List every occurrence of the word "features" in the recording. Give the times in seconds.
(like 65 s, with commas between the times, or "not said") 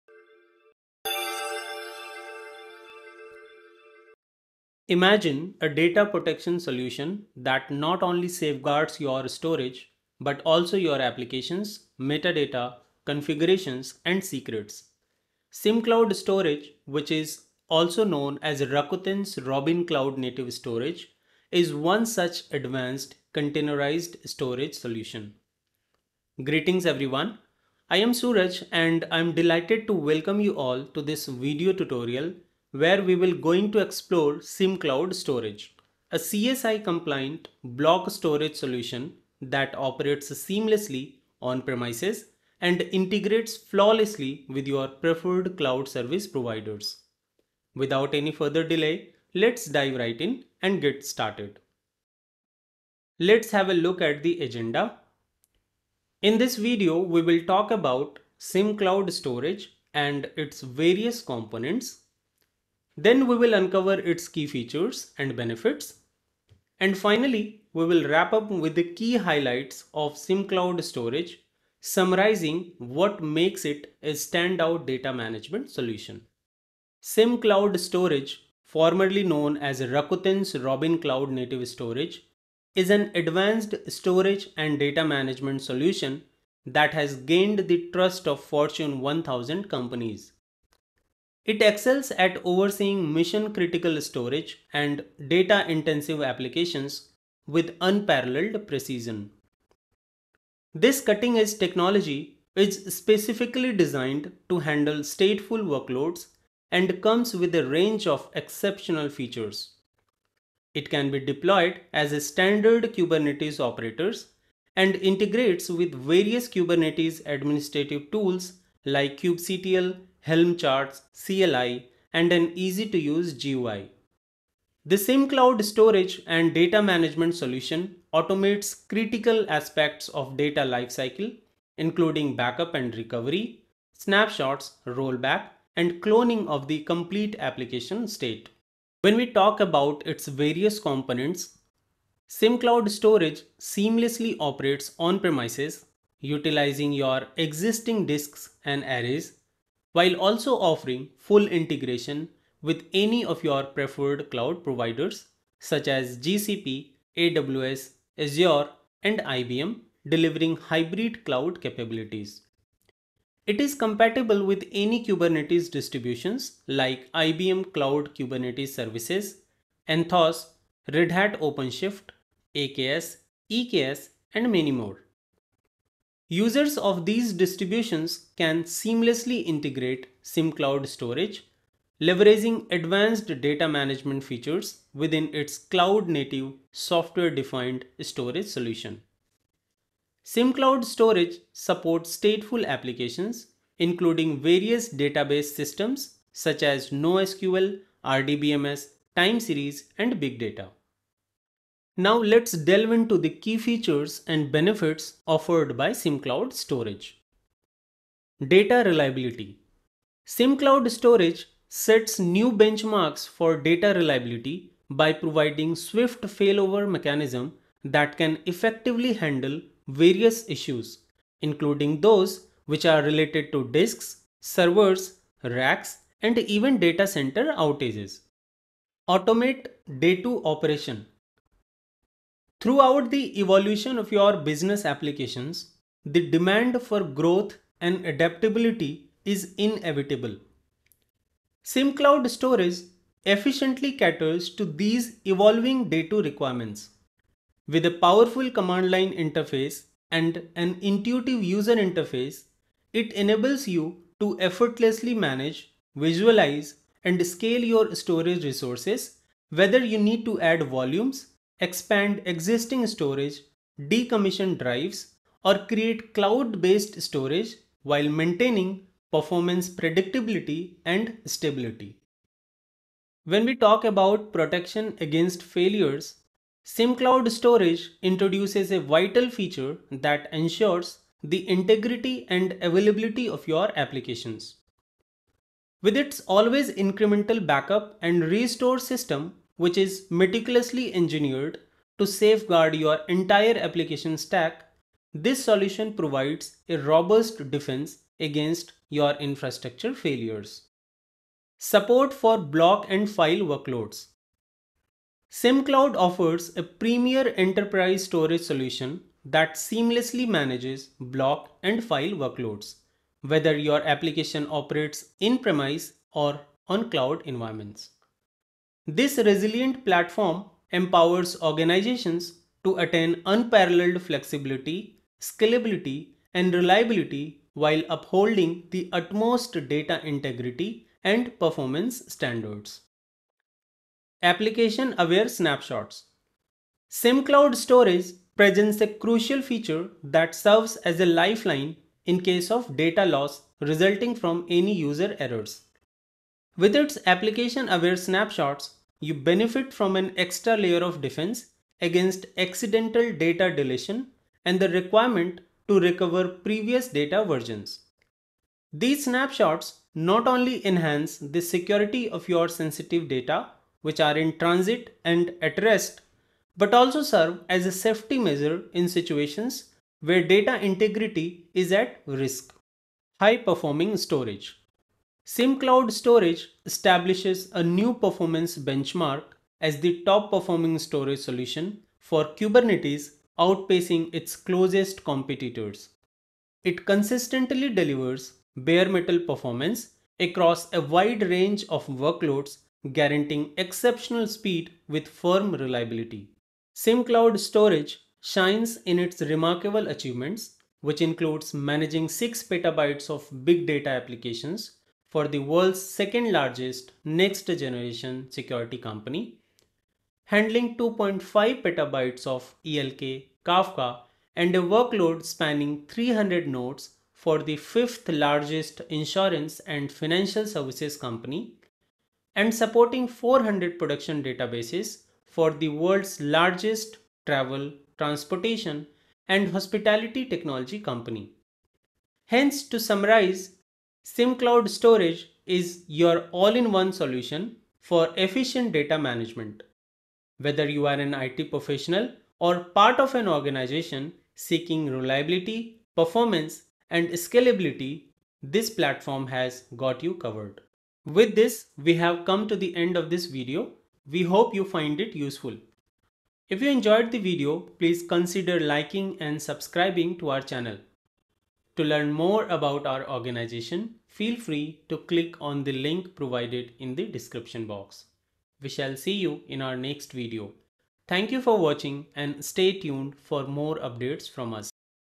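64 s, 109 s, 184 s, 203 s, 279 s, 339 s.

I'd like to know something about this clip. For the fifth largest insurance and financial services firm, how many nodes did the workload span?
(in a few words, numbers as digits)
300.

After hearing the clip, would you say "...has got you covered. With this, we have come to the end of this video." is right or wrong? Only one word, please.
right.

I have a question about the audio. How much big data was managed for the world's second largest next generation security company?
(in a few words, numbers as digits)
6 petabytes.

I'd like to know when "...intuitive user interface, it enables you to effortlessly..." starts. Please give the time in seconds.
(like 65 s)
250 s.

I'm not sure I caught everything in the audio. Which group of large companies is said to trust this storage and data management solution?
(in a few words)
Fortune 1000 companies.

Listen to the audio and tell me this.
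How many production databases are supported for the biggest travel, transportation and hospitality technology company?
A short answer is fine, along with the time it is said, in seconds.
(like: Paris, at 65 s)
400, at 423 s.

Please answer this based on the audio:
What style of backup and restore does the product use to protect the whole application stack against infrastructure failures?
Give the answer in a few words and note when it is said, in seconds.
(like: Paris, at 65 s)
Always incremental, at 286 s.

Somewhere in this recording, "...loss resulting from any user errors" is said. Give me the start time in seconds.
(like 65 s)
343 s.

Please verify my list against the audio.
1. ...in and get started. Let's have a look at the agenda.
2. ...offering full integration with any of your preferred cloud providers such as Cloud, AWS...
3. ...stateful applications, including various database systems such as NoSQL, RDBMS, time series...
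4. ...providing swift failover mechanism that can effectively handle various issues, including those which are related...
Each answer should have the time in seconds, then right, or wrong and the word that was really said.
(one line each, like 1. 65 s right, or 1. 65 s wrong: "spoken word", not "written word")
1. 50 s right
2. 150 s wrong: "GCP", not "Cloud"
3. 192 s right
4. 215 s right.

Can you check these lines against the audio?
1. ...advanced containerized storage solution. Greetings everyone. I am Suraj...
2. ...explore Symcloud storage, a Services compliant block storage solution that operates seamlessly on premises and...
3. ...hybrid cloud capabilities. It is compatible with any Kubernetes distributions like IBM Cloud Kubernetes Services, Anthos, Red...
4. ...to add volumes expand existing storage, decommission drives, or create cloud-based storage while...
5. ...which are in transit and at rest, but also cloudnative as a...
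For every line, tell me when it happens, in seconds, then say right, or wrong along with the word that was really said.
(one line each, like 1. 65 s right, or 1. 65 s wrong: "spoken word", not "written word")
1. 22 s right
2. 33 s wrong: "CSI", not "Services"
3. 160 s right
4. 260 s right
5. 363 s wrong: "serve", not "cloudnative".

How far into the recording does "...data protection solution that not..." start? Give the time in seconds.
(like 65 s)
5 s.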